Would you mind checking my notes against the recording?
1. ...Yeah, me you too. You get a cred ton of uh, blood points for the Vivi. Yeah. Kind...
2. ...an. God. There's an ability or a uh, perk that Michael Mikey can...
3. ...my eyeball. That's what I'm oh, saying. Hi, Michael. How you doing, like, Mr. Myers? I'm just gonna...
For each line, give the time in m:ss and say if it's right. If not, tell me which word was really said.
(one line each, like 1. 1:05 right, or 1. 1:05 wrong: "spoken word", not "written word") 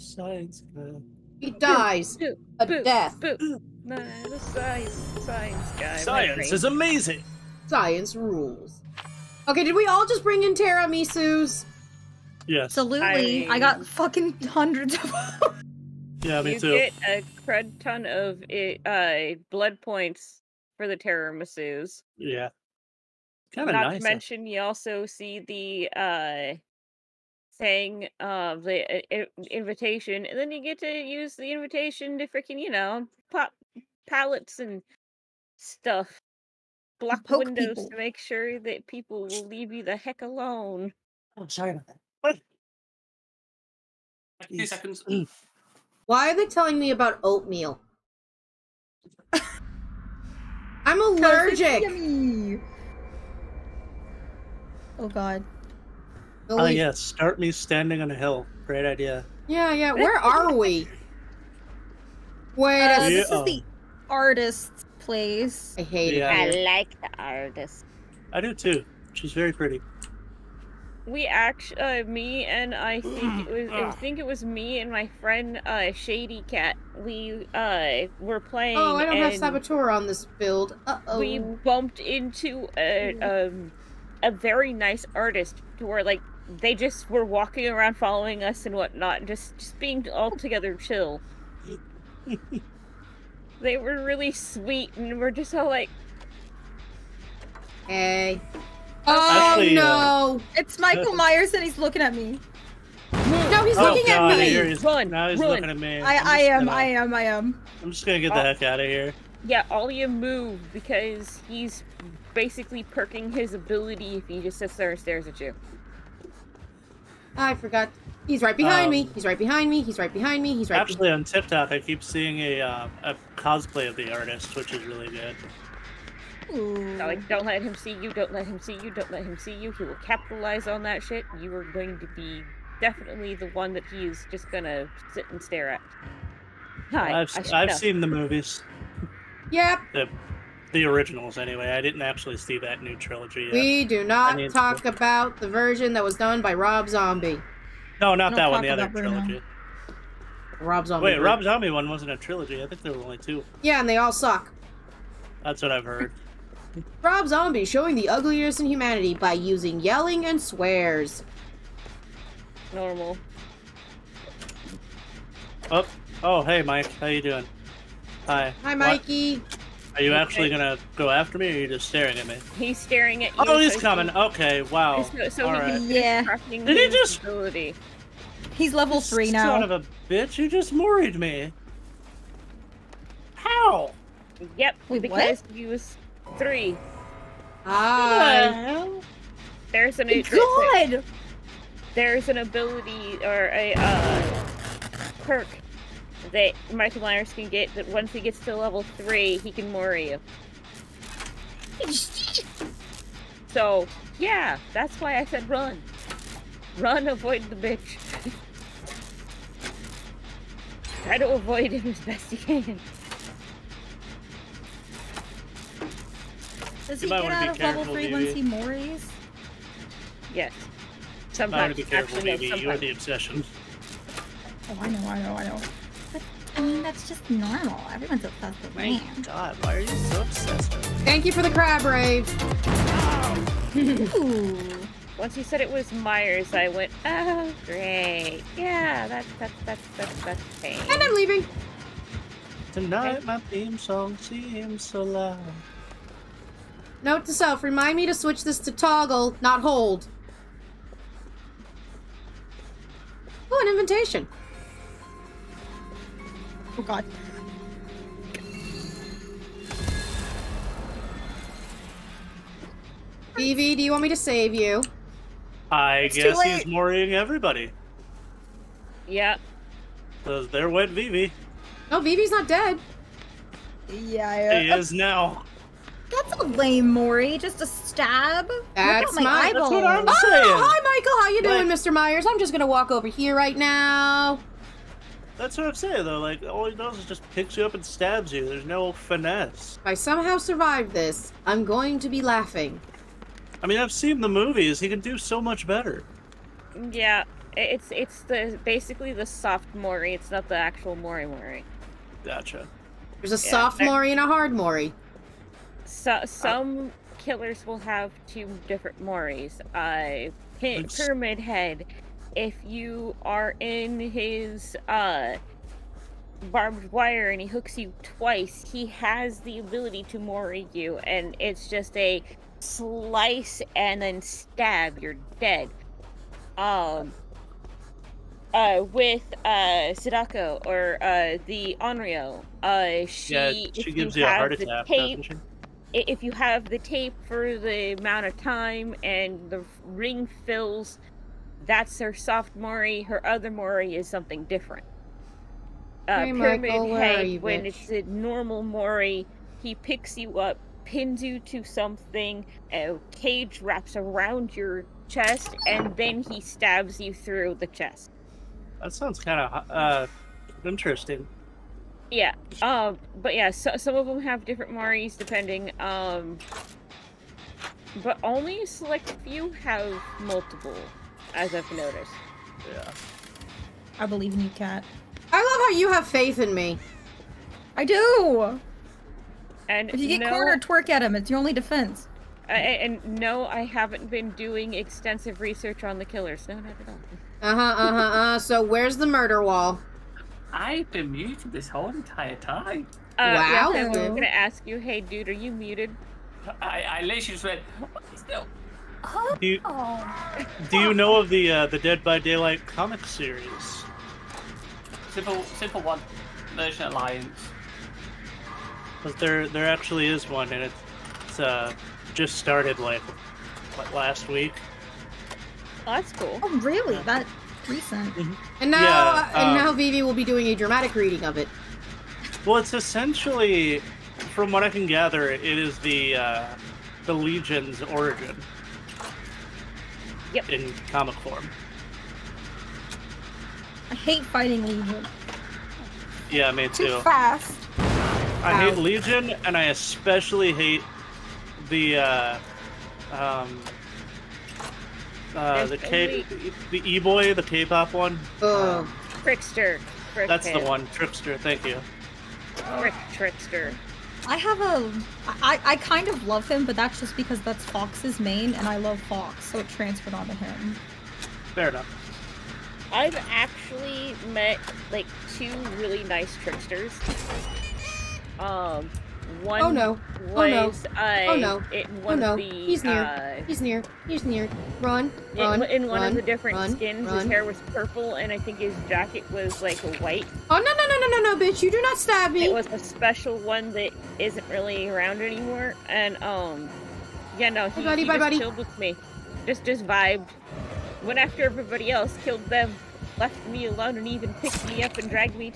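1. 0:16 wrong: "Misus", not "Vivi"
2. 3:09 wrong: "Myers", not "Mikey"
3. 4:39 right.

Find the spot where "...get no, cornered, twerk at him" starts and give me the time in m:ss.
6:20.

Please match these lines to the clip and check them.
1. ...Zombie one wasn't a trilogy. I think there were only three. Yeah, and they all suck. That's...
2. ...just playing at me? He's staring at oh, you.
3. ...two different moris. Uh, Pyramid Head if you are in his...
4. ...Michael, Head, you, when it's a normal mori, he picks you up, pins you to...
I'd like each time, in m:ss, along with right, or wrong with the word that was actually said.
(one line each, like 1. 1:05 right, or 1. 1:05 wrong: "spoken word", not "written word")
1. 2:31 wrong: "two", not "three"
2. 2:51 wrong: "staring", not "playing"
3. 5:08 right
4. 5:46 right.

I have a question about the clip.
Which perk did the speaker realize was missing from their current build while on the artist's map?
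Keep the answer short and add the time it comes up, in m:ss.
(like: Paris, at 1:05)
Saboteur, at 1:19.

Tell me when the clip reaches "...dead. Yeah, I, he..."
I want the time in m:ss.
4:32.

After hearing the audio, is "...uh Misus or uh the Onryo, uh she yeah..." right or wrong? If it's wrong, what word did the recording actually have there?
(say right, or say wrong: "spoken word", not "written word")
wrong: "Sadako", not "Misus".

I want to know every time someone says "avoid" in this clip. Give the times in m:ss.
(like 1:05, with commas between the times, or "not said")
3:27, 3:31.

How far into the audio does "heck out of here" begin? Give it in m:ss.
1:48.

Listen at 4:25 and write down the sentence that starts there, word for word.
I it's guess he's worrying everybody.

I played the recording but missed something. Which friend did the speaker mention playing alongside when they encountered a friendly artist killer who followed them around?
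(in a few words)
Shady Cat.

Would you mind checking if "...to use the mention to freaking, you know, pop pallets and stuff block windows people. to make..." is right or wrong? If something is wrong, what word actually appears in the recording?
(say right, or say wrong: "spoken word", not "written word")
wrong: "invitation", not "mention".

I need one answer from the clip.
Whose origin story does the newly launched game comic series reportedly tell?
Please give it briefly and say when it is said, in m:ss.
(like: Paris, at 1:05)
the Legion, at 7:07.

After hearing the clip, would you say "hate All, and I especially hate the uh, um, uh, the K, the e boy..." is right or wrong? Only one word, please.
wrong.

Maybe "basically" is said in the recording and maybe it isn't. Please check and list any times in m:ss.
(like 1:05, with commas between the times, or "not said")
1:52, 4:58.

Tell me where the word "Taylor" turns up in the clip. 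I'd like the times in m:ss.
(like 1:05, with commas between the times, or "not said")
not said.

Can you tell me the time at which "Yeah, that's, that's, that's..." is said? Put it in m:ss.
3:58.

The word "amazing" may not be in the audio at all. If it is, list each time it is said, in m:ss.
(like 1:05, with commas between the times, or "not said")
0:06.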